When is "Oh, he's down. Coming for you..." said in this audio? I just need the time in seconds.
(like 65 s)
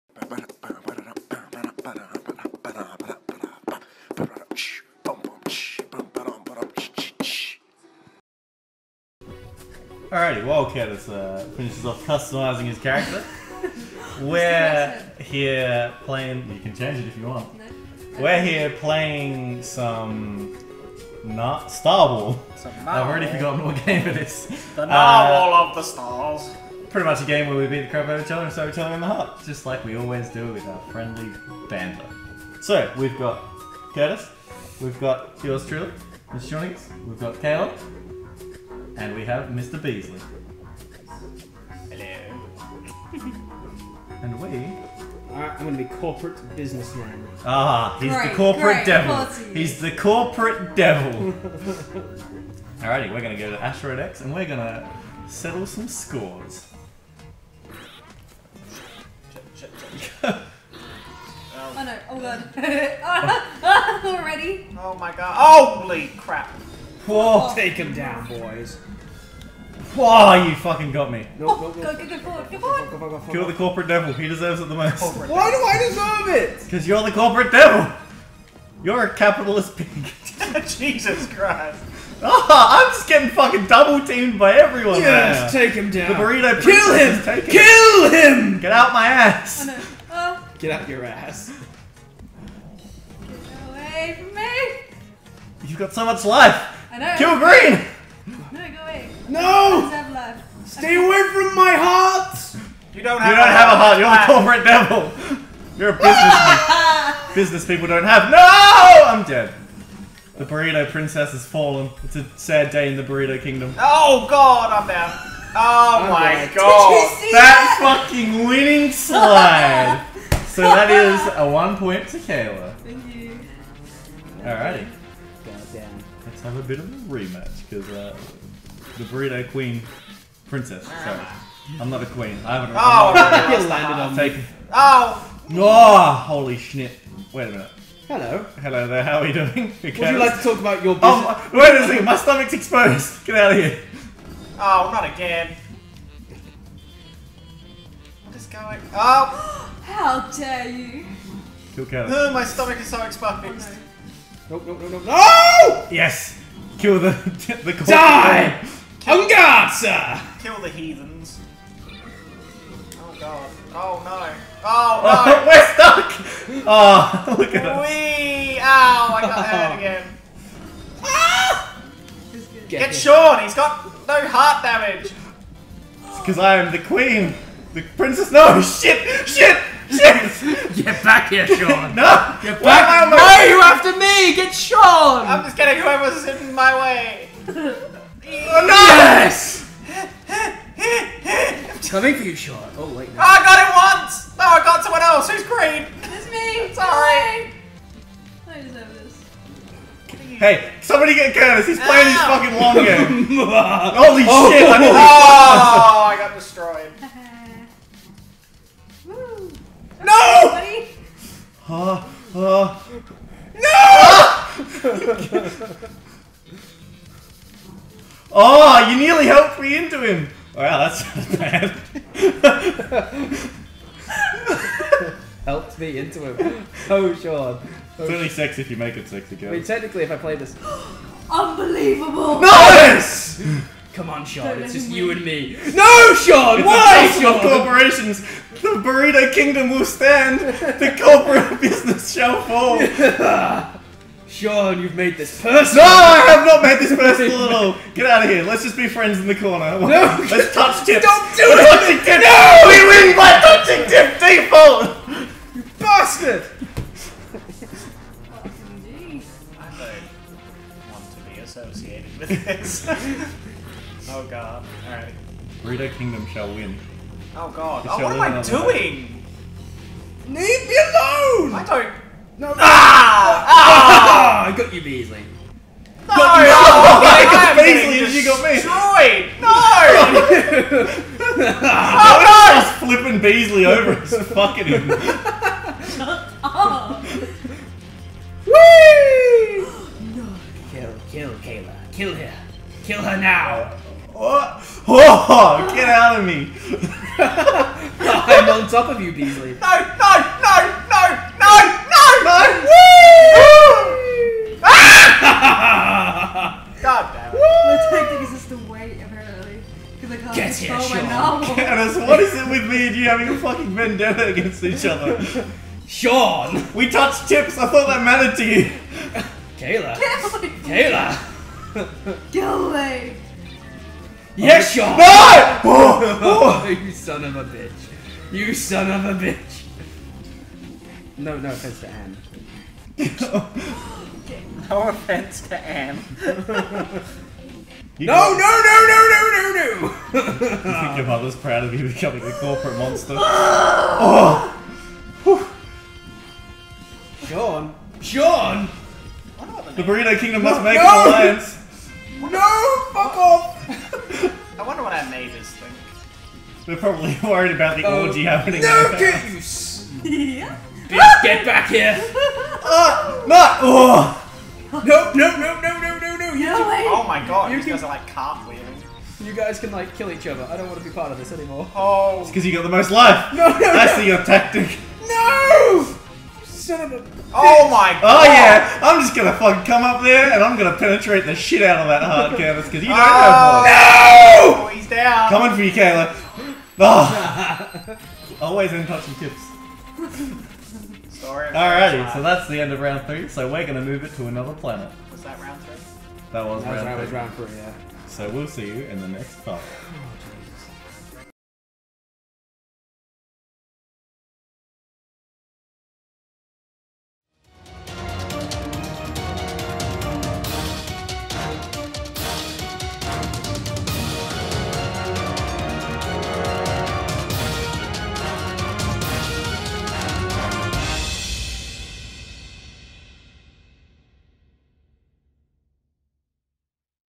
384 s.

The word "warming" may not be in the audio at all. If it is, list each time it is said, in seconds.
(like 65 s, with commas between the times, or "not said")
not said.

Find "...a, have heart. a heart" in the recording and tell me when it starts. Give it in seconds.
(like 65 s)
103 s.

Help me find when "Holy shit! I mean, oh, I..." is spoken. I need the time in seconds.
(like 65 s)
203 s.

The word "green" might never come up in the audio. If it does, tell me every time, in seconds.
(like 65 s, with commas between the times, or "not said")
97 s, 195 s.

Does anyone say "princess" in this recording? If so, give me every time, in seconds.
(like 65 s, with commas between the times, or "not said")
110 s, 130 s, 177 s.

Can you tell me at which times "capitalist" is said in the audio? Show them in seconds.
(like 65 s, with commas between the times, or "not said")
79 s.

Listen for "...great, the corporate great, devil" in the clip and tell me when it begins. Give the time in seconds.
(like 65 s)
48 s.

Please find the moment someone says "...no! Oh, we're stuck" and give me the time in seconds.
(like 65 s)
165 s.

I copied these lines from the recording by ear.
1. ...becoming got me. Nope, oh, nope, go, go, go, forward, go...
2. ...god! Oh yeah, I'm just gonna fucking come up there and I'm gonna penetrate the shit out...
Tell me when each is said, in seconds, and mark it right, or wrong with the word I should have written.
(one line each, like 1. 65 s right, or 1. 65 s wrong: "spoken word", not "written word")
1. 70 s wrong: "fucking", not "becoming"
2. 378 s right.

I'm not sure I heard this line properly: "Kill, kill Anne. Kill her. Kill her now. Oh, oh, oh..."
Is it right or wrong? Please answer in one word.
wrong.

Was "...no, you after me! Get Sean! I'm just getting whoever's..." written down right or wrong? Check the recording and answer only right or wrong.
right.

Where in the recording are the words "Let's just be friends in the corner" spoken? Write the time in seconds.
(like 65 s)
248 s.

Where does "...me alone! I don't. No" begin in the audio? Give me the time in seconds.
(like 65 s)
270 s.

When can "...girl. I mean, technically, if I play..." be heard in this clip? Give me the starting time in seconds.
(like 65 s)
229 s.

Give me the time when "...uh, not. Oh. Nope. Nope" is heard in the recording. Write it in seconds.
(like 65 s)
363 s.